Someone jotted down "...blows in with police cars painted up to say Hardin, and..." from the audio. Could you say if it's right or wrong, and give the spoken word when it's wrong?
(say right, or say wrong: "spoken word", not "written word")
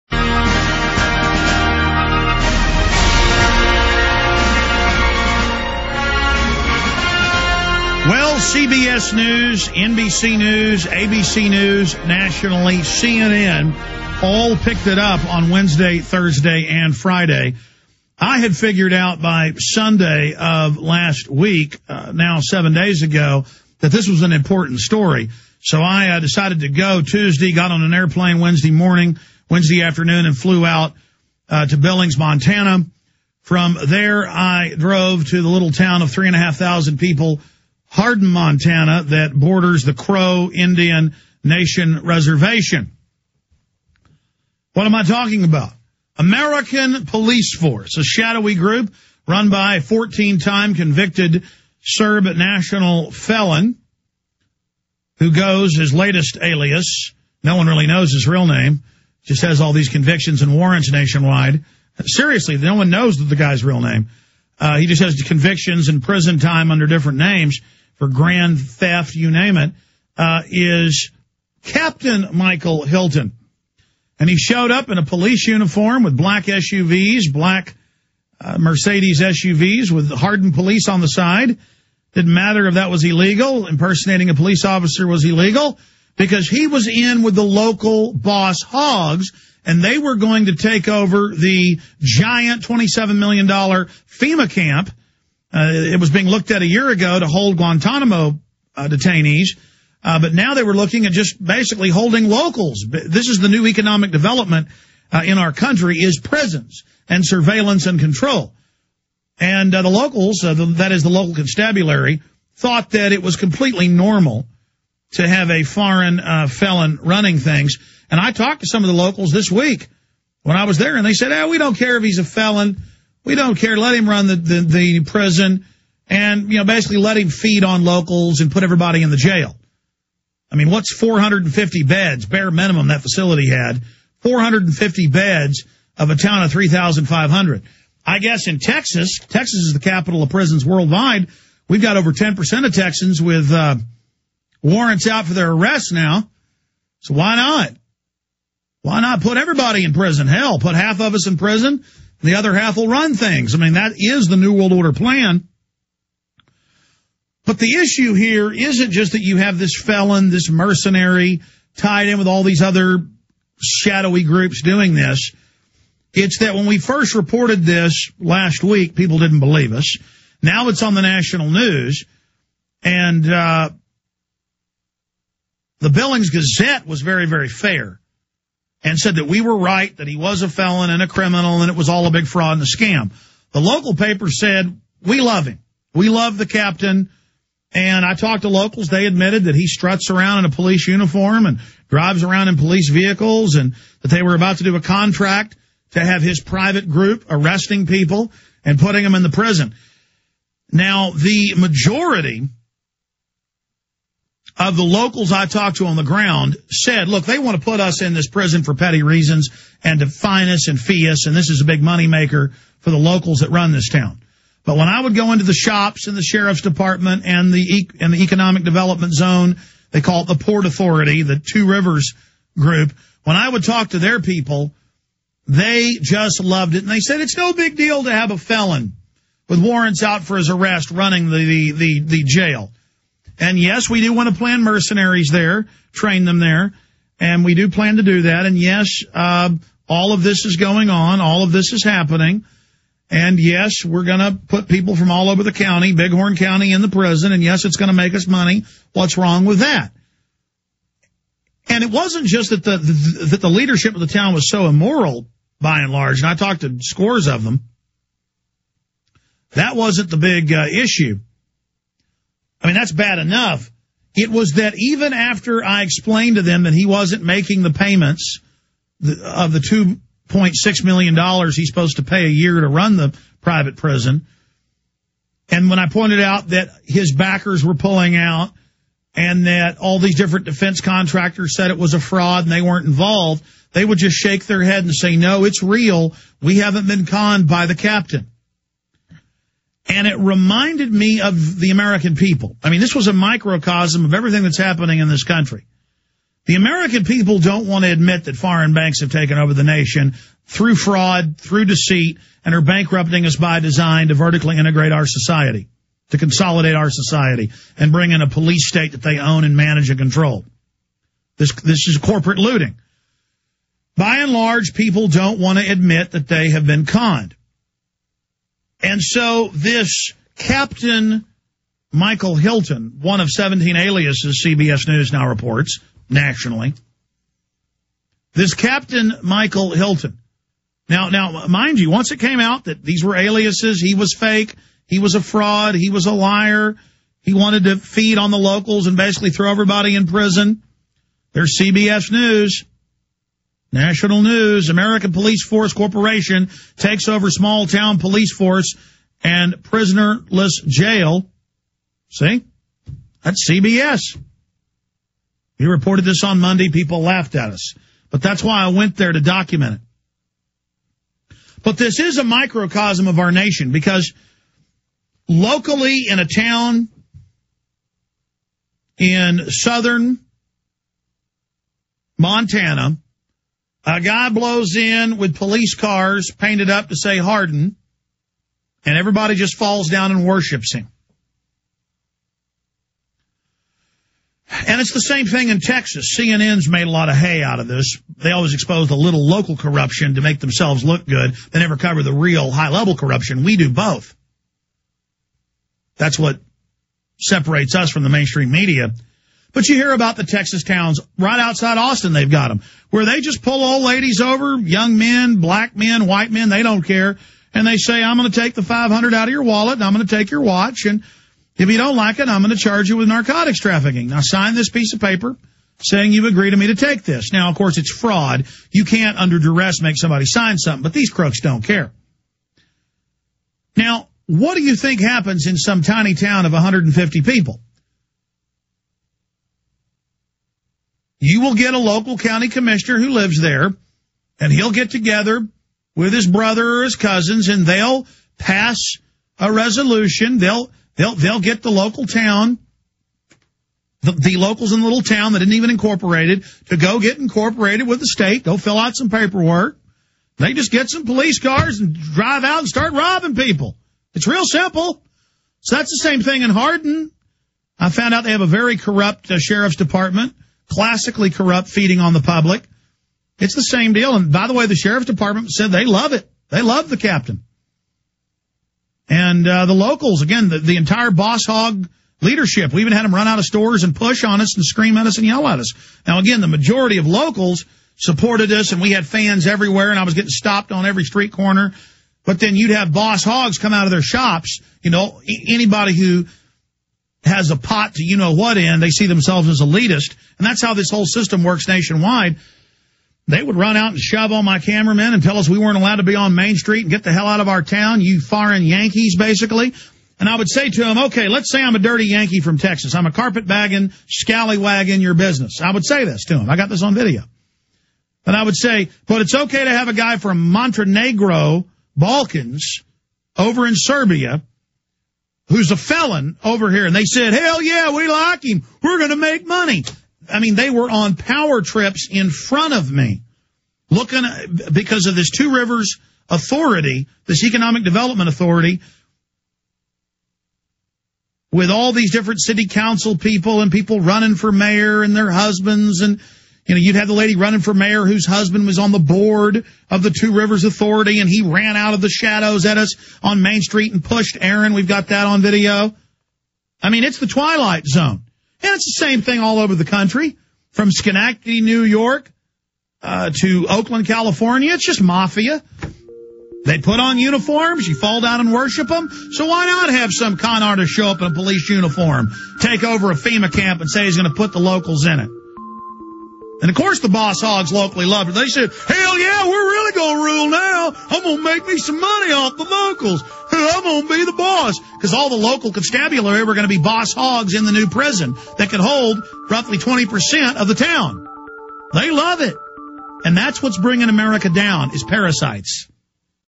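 right.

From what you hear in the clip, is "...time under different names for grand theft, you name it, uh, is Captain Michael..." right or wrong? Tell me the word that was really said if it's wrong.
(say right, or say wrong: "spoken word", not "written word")
right.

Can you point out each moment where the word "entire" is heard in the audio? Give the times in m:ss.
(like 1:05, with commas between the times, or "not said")
7:50.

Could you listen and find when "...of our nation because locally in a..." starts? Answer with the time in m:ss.
6:03.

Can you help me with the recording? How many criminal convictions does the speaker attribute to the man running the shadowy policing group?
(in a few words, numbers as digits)
14.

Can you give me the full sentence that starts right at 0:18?
I had figured out by Sunday of last week, uh, now seven days ago, that this was an important story.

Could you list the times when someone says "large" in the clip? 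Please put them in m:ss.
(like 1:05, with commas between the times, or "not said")
4:15, 5:14.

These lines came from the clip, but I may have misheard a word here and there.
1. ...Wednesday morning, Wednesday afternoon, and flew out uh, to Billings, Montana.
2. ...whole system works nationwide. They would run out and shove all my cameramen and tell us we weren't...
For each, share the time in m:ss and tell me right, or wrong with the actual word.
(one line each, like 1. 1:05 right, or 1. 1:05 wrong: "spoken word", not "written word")
1. 0:28 right
2. 8:10 right.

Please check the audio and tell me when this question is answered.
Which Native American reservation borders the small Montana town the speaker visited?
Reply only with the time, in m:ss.
0:39.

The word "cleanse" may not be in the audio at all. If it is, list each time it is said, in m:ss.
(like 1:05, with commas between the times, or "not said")
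not said.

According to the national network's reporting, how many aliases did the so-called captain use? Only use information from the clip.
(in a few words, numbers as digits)
17.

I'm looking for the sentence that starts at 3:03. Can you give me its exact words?
The local paper said, we love him.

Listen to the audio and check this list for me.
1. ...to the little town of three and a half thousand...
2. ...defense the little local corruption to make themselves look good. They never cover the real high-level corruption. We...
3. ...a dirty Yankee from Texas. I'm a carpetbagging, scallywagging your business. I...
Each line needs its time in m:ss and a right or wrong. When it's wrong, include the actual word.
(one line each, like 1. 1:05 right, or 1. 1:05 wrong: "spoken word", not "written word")
1. 0:35 right
2. 6:28 wrong: "expose", not "defense"
3. 8:21 right.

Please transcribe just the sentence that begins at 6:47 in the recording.
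And they say, I'm going to take the 500 out of your wallet and I'm going to take your watch.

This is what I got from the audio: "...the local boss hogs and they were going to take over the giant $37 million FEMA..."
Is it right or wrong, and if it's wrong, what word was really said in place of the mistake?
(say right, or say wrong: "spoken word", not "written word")
wrong: "27", not "37".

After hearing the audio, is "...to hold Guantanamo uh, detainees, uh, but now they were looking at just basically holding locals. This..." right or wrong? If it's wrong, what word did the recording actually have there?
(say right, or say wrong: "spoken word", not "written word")
right.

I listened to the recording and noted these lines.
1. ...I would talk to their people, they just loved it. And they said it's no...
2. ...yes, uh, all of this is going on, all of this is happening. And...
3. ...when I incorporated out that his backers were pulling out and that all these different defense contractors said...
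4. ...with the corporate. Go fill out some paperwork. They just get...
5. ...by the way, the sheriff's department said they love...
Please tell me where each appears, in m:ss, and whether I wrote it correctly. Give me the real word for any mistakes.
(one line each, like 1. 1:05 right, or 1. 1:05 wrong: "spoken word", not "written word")
1. 3:43 right
2. 3:58 right
3. 4:35 wrong: "pointed", not "incorporated"
4. 7:27 wrong: "state", not "corporate"
5. 7:44 right.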